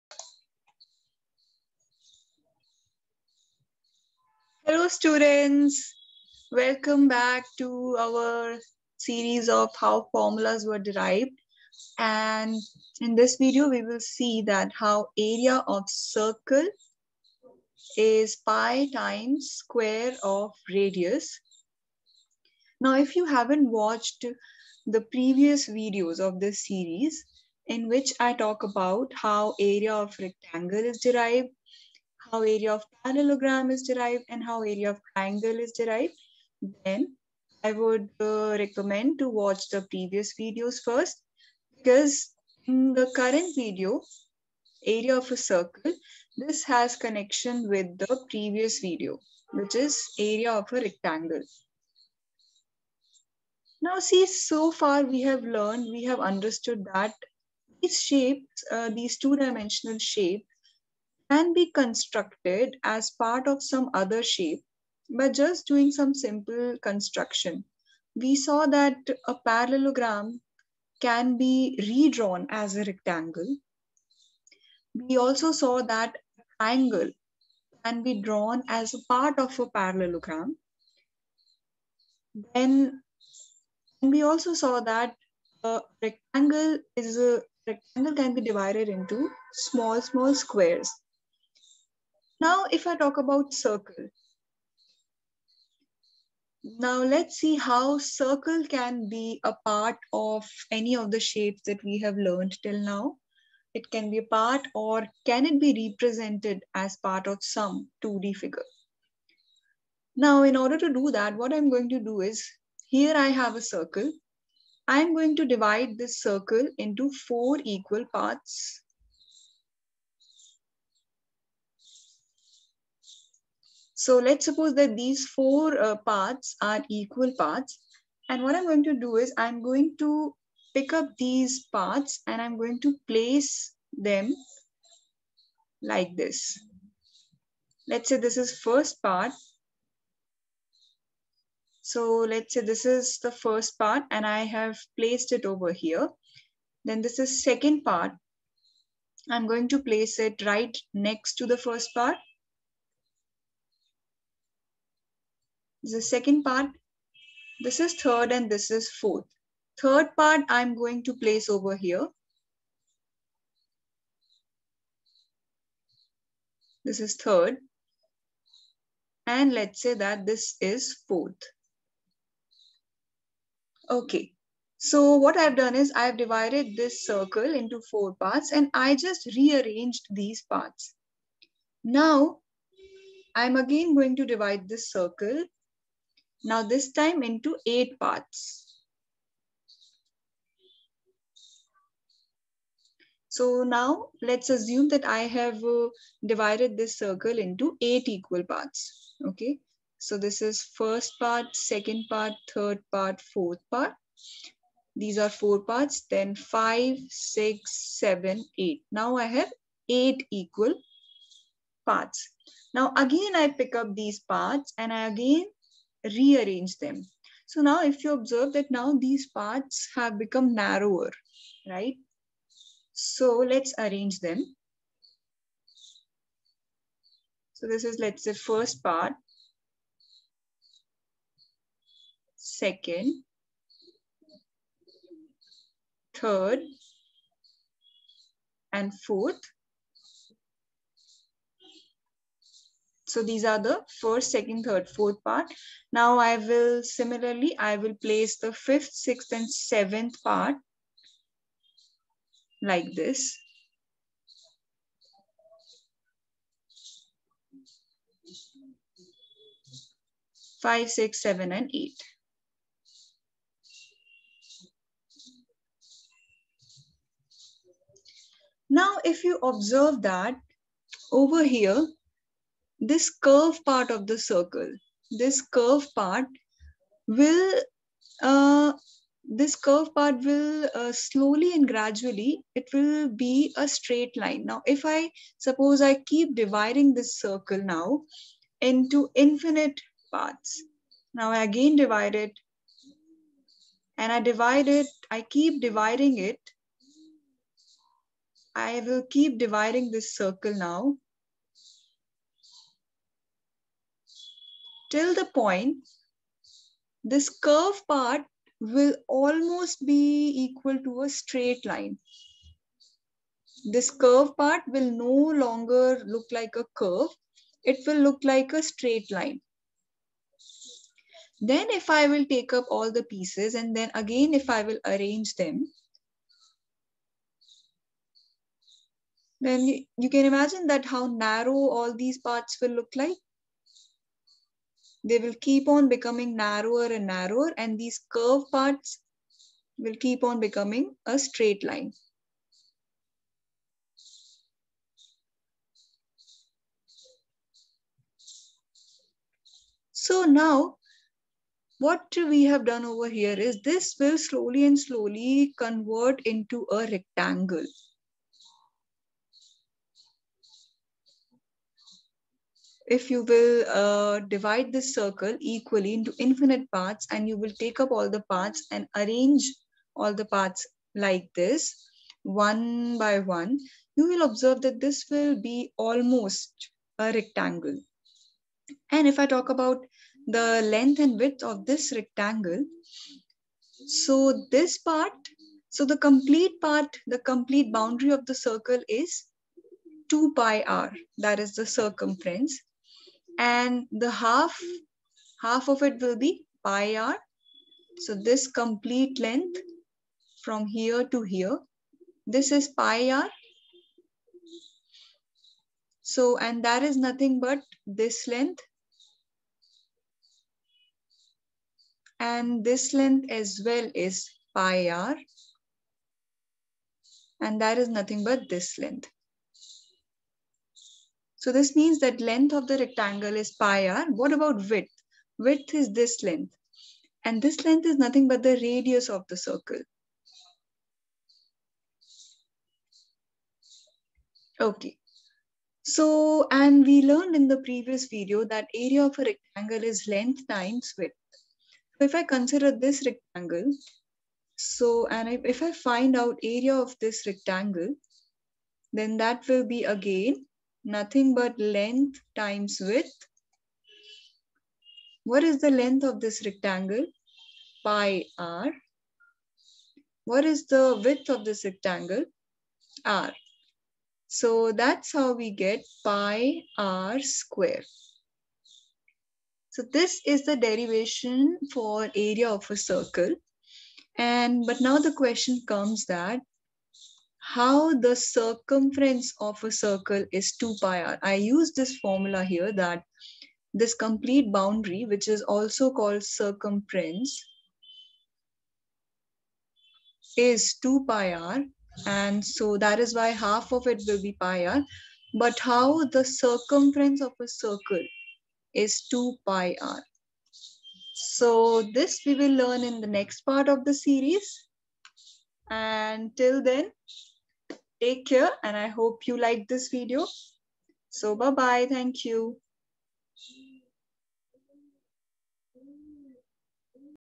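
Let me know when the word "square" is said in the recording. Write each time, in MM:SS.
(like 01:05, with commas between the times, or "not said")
00:19, 01:30, 07:47.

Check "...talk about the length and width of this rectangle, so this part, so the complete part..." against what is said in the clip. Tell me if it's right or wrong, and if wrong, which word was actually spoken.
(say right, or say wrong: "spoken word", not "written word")
right.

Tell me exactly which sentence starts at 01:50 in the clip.
Now, in order to do that, what I'm going to do is, here I have a circle.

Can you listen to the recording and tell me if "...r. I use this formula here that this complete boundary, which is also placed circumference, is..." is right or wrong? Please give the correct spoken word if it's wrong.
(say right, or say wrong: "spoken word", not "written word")
wrong: "called", not "placed".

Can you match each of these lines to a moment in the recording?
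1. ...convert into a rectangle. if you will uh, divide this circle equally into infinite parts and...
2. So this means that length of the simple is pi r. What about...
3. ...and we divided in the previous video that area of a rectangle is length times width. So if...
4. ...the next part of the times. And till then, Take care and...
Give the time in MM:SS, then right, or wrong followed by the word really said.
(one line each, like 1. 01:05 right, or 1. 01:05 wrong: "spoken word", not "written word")
1. 05:55 right
2. 07:01 wrong: "rectangle", not "simple"
3. 07:16 wrong: "learned", not "divided"
4. 08:23 wrong: "series", not "times".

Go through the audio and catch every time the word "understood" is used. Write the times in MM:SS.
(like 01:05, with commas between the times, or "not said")
00:56.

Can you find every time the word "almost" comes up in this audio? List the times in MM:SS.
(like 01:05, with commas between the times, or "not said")
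05:09, 06:15.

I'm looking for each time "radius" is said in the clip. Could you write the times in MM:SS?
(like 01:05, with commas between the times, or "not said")
00:20, 07:08.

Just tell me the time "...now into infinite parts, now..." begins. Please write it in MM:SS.
04:47.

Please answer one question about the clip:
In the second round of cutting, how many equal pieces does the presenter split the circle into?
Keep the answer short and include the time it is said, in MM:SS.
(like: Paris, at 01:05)
8, at 03:07.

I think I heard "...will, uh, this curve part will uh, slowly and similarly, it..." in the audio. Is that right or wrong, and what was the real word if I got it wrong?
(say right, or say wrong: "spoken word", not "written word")
wrong: "gradually", not "similarly".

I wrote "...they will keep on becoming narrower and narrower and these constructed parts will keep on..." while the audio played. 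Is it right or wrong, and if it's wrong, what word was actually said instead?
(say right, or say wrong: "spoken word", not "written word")
wrong: "curved", not "constructed".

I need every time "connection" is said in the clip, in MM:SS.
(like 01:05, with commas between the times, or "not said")
00:46.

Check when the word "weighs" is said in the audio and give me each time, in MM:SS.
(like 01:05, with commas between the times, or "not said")
not said.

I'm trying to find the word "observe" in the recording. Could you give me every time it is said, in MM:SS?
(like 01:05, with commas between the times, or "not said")
03:38, 04:29, 06:14.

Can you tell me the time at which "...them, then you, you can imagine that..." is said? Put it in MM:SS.
05:25.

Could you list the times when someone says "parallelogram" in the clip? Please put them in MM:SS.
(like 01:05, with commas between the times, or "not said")
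00:33, 01:09, 01:19.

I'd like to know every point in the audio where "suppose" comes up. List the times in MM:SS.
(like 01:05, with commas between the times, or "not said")
02:04, 04:45.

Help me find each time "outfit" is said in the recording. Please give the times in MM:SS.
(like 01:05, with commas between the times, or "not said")
not said.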